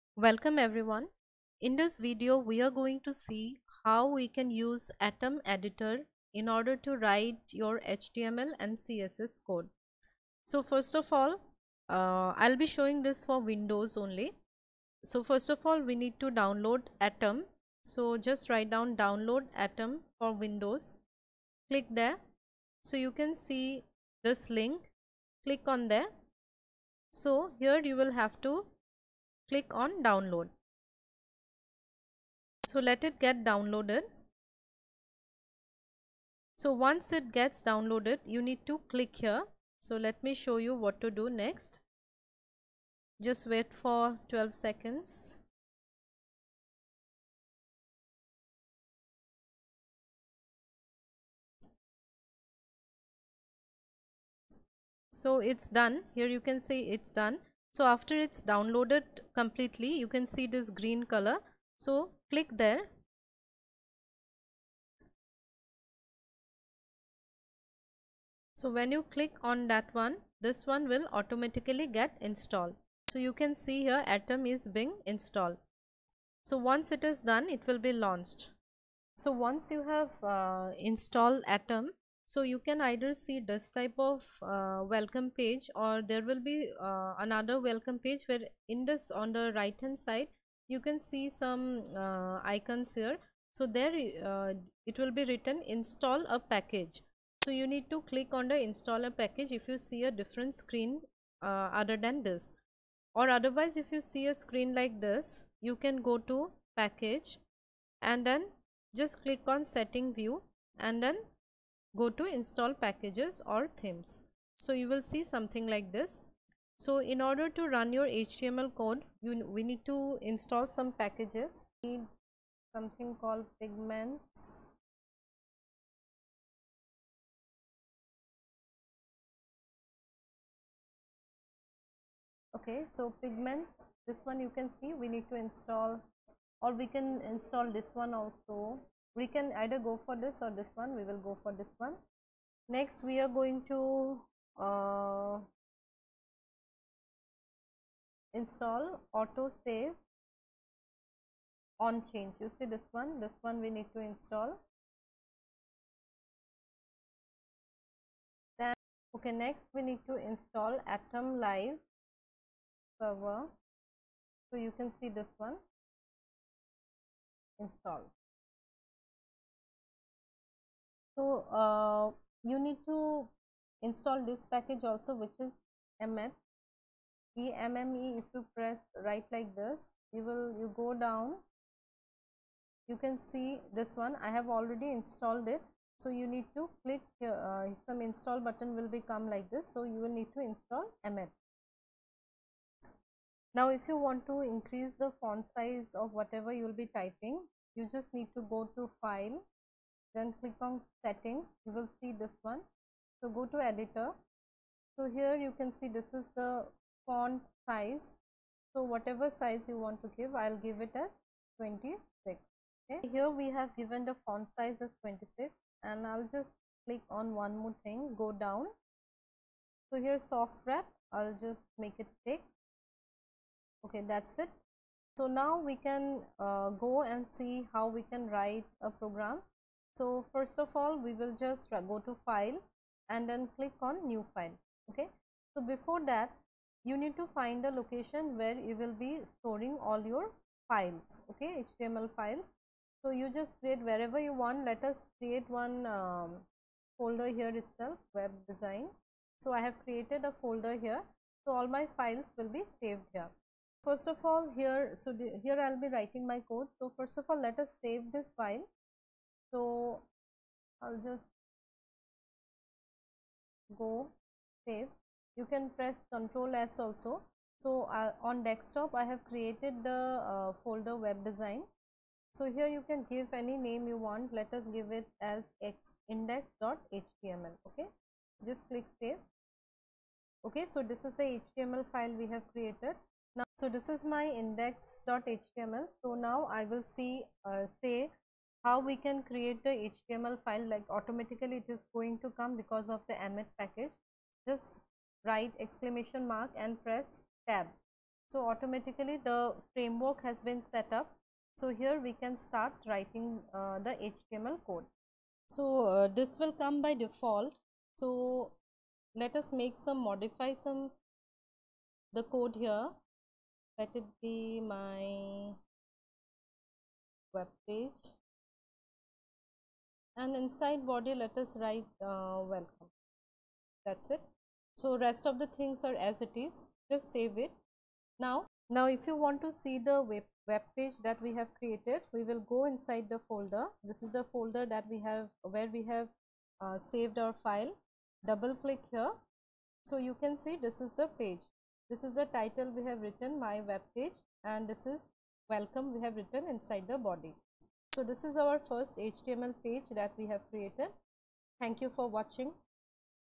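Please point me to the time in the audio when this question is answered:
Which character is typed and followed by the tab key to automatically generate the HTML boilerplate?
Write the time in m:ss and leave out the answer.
4:55.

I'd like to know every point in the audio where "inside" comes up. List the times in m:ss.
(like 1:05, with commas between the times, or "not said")
5:20, 5:32, 5:46.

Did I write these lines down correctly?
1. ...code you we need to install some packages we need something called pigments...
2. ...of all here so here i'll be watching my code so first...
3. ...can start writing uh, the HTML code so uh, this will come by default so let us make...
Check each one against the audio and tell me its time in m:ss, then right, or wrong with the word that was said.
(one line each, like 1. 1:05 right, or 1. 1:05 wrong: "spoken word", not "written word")
1. 1:58 right
2. 4:14 wrong: "writing", not "watching"
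3. 5:02 right.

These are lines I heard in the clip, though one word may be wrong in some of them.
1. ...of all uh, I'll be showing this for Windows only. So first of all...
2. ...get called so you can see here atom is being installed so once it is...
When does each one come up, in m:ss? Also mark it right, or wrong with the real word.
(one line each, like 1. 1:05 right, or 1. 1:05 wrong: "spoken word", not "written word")
1. 0:10 right
2. 1:11 wrong: "installed", not "called".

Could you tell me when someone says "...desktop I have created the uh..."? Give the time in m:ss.
4:28.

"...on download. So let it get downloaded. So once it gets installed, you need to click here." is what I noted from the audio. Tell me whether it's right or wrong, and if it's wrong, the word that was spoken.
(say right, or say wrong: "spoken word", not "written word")
wrong: "downloaded", not "installed".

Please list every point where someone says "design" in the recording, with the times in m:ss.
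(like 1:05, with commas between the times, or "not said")
4:08, 4:31.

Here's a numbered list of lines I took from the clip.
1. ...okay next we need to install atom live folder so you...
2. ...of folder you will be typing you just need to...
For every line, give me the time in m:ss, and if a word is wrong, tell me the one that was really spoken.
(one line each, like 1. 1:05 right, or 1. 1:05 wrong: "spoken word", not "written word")
1. 2:39 wrong: "server", not "folder"
2. 3:16 wrong: "whatever", not "folder".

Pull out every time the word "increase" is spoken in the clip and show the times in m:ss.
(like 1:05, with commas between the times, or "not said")
3:14.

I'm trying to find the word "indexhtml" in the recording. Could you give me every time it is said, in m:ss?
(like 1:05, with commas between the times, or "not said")
4:36, 4:44.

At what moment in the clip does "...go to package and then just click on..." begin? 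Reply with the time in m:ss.
1:46.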